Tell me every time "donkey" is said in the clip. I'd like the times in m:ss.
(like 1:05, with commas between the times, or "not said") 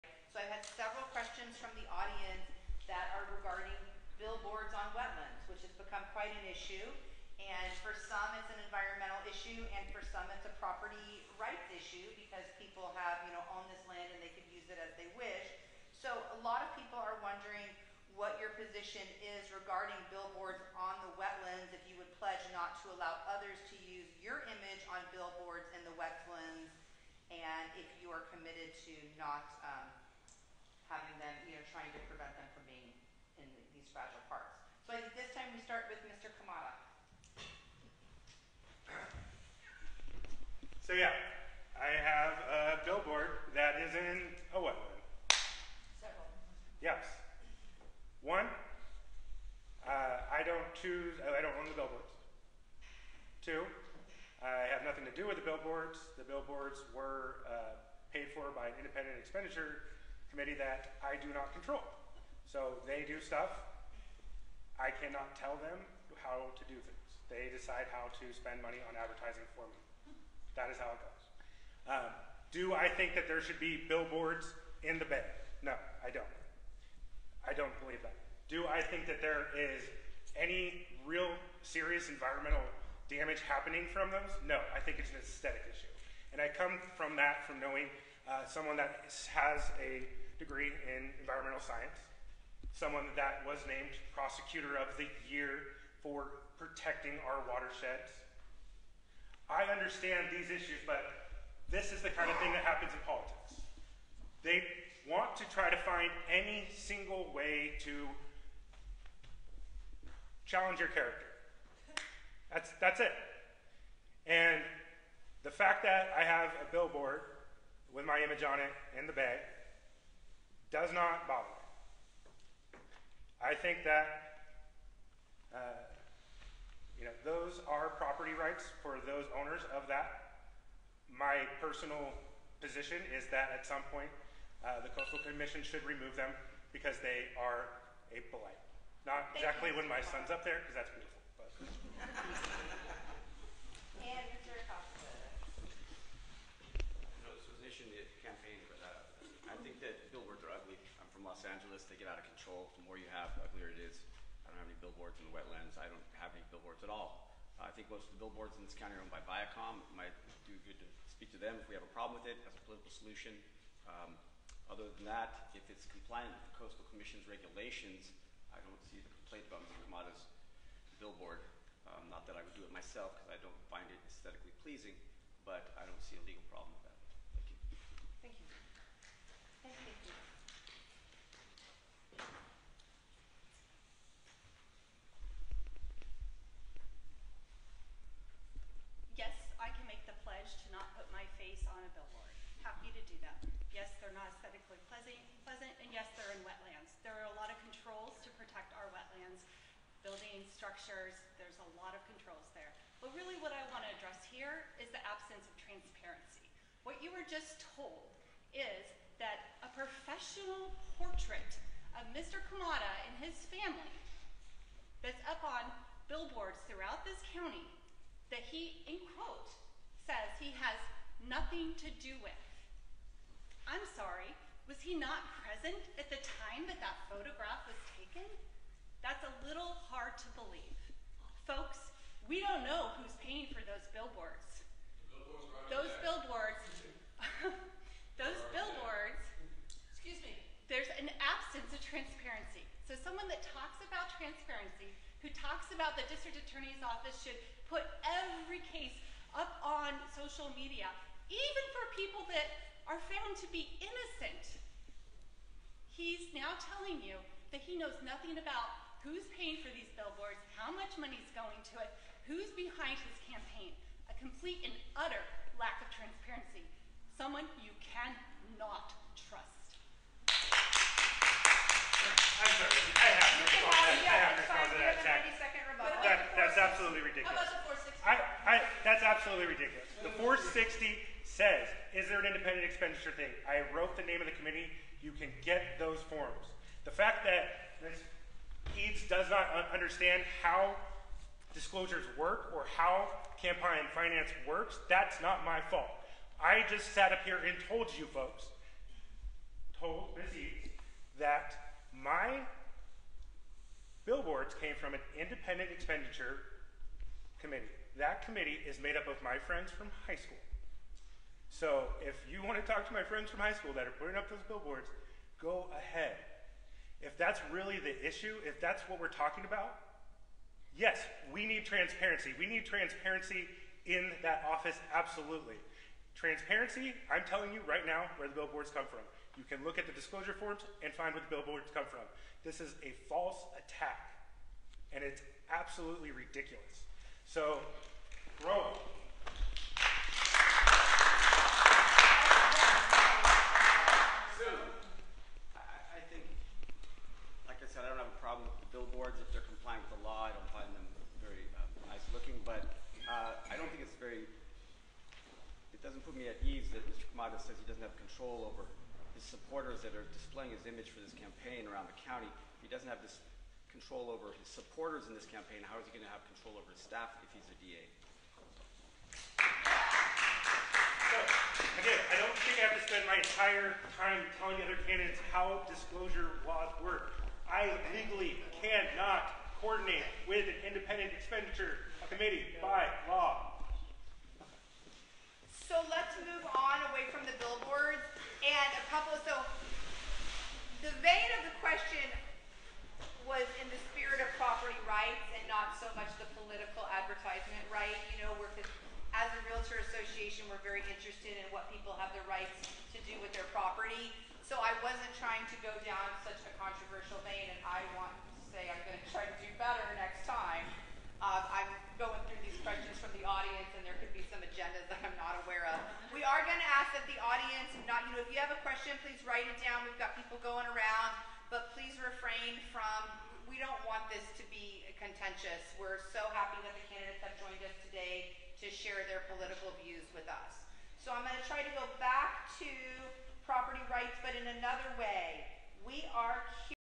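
not said.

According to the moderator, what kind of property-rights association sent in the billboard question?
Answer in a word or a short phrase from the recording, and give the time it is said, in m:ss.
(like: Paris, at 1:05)
Realtor Association, at 6:39.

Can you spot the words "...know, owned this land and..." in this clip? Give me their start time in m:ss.
0:13.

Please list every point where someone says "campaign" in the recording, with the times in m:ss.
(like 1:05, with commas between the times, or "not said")
4:23, 4:53, 6:01, 6:05.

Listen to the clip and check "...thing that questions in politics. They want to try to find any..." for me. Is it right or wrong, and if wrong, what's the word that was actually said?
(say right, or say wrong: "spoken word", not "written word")
wrong: "happens", not "questions".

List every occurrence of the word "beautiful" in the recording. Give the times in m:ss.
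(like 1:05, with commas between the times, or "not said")
2:20.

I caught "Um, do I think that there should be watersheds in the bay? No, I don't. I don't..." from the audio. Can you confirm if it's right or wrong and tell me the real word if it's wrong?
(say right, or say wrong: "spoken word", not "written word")
wrong: "billboards", not "watersheds".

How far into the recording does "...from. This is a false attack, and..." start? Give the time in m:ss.
5:31.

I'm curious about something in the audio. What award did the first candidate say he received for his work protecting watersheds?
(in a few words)
Prosecutor of the Year.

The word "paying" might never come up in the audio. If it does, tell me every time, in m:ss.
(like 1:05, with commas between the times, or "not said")
3:53, 4:19.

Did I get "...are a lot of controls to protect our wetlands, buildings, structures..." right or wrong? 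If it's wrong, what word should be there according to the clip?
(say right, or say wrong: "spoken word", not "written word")
right.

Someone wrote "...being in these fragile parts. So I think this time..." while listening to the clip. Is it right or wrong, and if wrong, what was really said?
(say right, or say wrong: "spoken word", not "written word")
right.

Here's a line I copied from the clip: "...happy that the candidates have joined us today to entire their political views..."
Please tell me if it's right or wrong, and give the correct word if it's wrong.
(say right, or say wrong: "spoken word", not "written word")
wrong: "share", not "entire".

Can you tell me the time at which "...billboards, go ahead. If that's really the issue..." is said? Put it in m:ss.
5:14.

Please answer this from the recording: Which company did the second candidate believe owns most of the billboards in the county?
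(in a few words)
Viacom.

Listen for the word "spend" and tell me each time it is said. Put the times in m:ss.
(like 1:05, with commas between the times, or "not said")
1:08, 6:12.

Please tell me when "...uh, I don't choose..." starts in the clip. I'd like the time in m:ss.
0:49.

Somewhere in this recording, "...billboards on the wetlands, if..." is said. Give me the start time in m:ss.
0:20.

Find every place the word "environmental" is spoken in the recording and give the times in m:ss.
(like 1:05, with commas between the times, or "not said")
0:08, 1:22, 1:31.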